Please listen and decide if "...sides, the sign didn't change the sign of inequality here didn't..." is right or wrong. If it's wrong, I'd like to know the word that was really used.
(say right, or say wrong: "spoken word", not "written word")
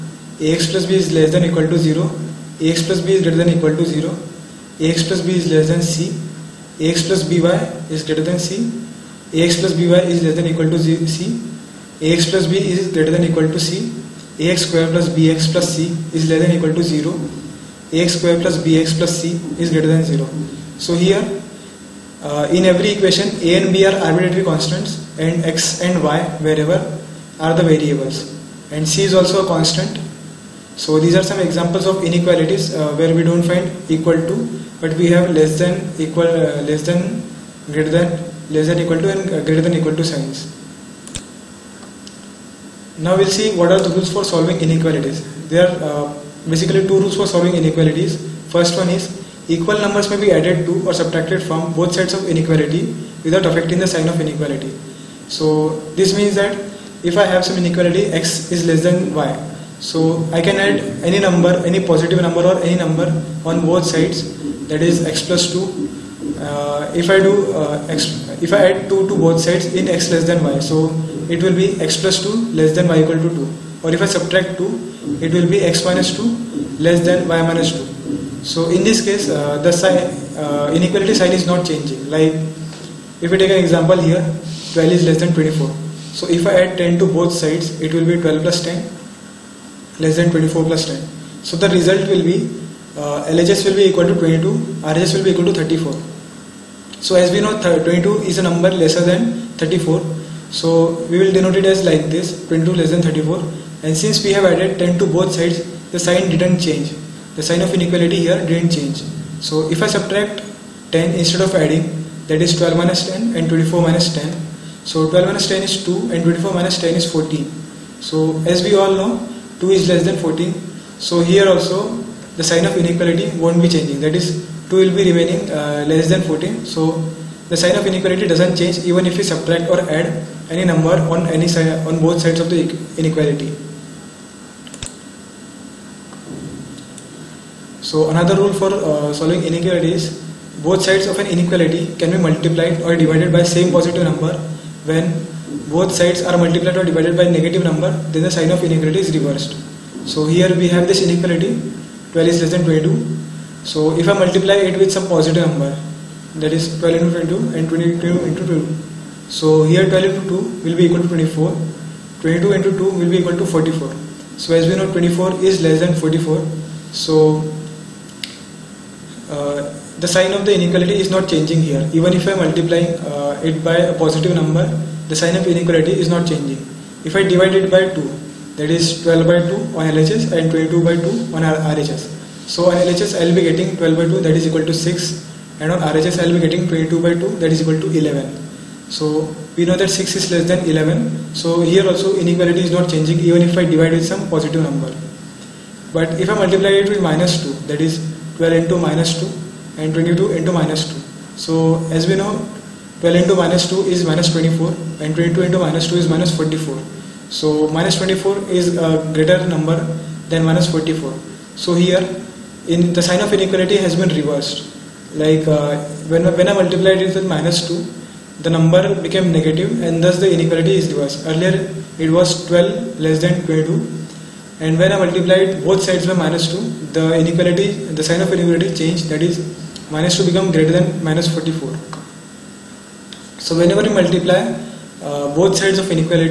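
right.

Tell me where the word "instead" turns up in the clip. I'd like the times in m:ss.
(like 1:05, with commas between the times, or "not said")
1:51.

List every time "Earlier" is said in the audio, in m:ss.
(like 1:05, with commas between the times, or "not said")
3:41.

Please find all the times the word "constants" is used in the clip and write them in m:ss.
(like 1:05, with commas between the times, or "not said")
0:24, 0:29.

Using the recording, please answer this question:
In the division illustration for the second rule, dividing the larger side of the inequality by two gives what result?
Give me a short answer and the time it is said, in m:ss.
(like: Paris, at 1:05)
11, at 3:07.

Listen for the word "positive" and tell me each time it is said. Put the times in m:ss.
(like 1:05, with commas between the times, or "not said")
1:01, 2:23, 2:35, 2:53, 3:14.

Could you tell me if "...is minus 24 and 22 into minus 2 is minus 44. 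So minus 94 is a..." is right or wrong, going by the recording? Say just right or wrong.
wrong.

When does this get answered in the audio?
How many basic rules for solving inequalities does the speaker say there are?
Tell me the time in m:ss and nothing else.
0:46.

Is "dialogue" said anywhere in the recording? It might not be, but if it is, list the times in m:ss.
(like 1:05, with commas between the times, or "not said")
not said.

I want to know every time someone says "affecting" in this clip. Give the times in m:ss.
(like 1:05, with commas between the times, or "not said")
0:53.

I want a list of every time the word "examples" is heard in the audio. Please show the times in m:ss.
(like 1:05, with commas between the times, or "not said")
0:31, 1:23.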